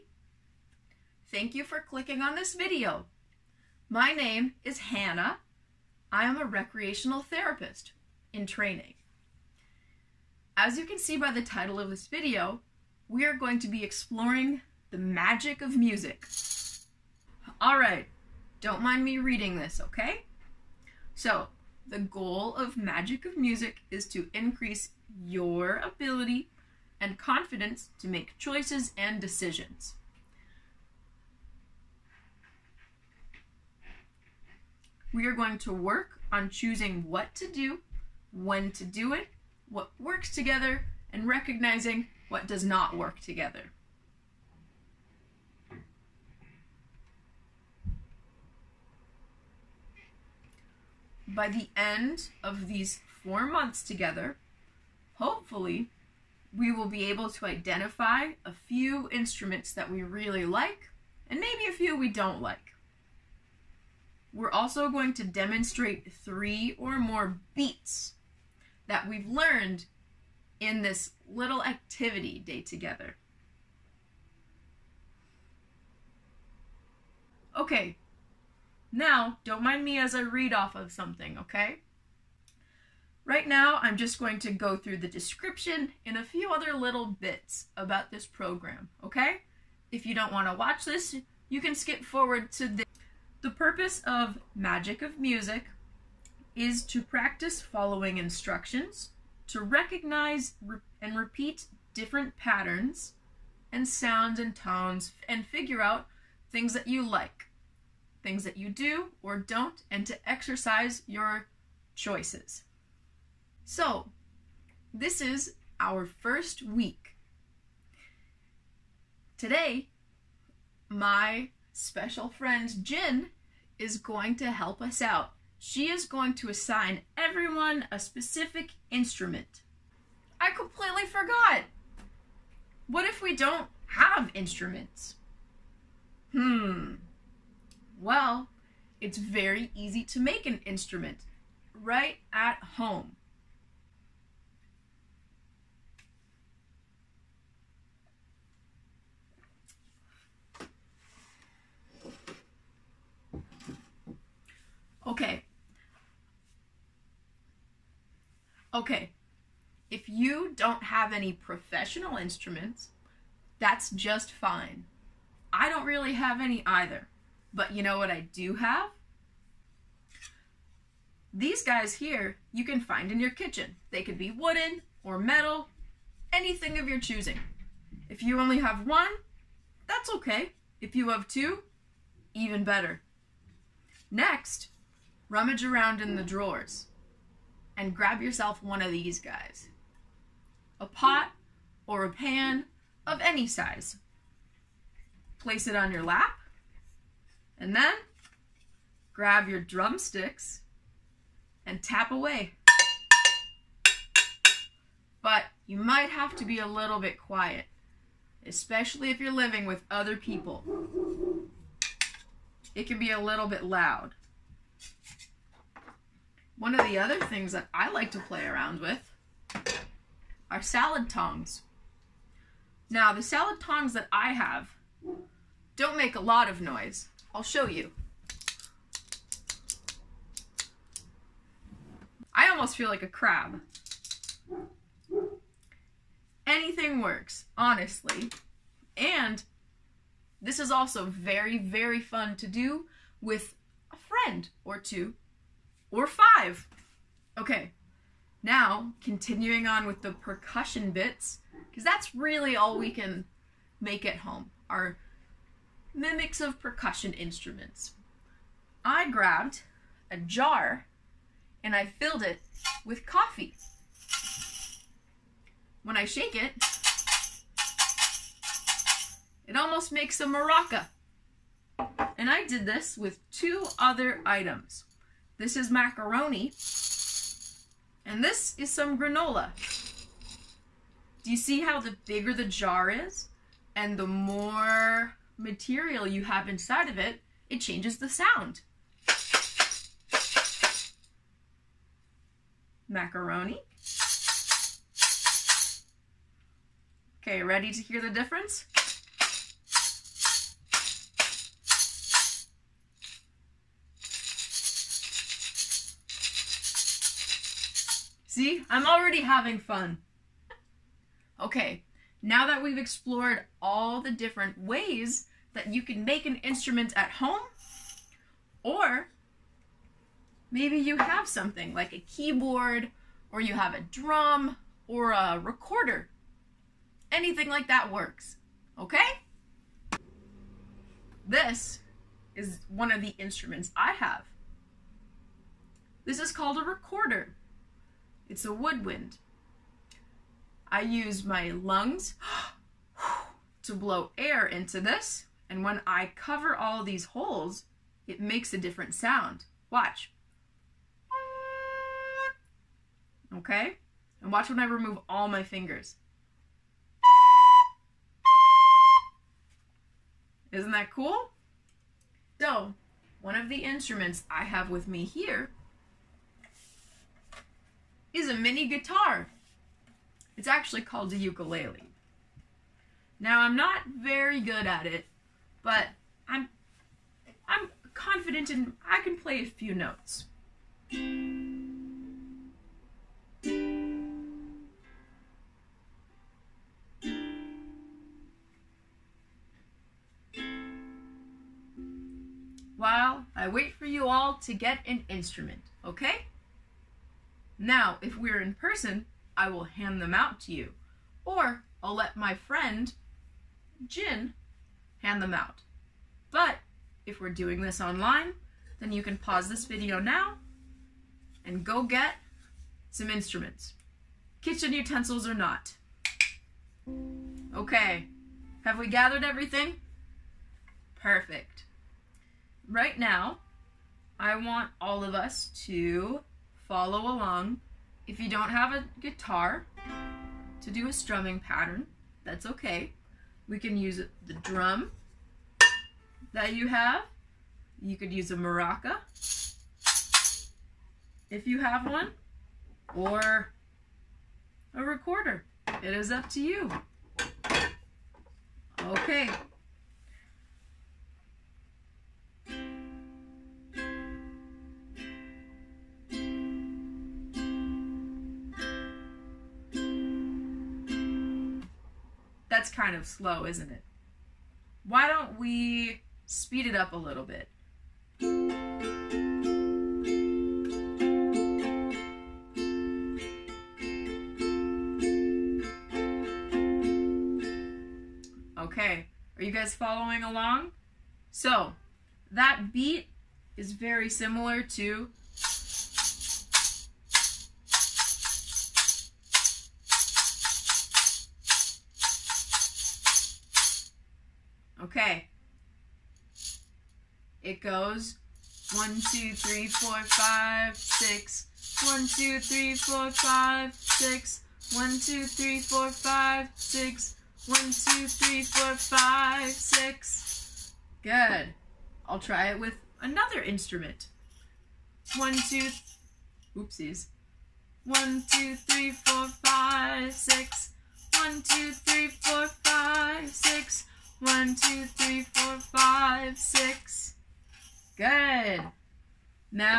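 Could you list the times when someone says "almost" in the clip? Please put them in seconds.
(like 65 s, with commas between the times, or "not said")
232 s, 269 s.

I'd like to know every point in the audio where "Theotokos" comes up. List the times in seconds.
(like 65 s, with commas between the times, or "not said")
not said.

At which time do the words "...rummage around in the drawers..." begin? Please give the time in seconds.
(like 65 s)
185 s.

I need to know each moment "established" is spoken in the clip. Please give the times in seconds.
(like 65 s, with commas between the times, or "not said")
not said.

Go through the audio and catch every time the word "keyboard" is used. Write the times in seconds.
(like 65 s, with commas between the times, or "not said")
322 s.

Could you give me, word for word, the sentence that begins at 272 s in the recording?
And I did this with two other items.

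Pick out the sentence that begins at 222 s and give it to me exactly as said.
Now, the salad tongs that I have don't make a lot of noise.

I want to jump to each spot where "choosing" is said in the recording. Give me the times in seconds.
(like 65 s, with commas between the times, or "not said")
36 s, 176 s.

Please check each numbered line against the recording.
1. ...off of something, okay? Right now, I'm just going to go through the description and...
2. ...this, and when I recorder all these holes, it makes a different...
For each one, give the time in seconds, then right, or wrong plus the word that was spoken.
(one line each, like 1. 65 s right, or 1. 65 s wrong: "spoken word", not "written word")
1. 80 s right
2. 344 s wrong: "cover", not "recorder".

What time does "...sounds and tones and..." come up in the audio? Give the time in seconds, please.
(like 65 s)
103 s.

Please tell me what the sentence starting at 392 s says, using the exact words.
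While I wait for you all to get an instrument, okay?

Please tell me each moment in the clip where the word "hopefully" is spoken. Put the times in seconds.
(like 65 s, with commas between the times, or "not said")
55 s.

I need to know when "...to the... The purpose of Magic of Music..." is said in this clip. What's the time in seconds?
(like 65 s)
92 s.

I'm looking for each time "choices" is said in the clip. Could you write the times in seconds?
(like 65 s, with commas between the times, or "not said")
28 s, 111 s.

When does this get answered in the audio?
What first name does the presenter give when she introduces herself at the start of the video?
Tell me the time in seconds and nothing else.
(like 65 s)
4 s.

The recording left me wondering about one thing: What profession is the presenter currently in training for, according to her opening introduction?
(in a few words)
Recreational therapist.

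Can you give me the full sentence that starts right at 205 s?
But you might have to be a little bit quiet, especially if you're living with other people.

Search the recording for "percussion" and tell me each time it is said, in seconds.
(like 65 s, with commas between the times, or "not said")
250 s, 256 s.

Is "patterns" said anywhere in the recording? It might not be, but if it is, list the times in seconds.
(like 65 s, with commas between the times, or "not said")
102 s, 431 s.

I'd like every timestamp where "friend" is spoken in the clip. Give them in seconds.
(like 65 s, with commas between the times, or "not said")
122 s, 243 s, 402 s.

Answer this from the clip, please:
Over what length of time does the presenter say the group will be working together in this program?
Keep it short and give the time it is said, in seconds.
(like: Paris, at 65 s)
4 months, at 53 s.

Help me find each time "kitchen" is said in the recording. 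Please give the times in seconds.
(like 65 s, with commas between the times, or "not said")
173 s, 414 s.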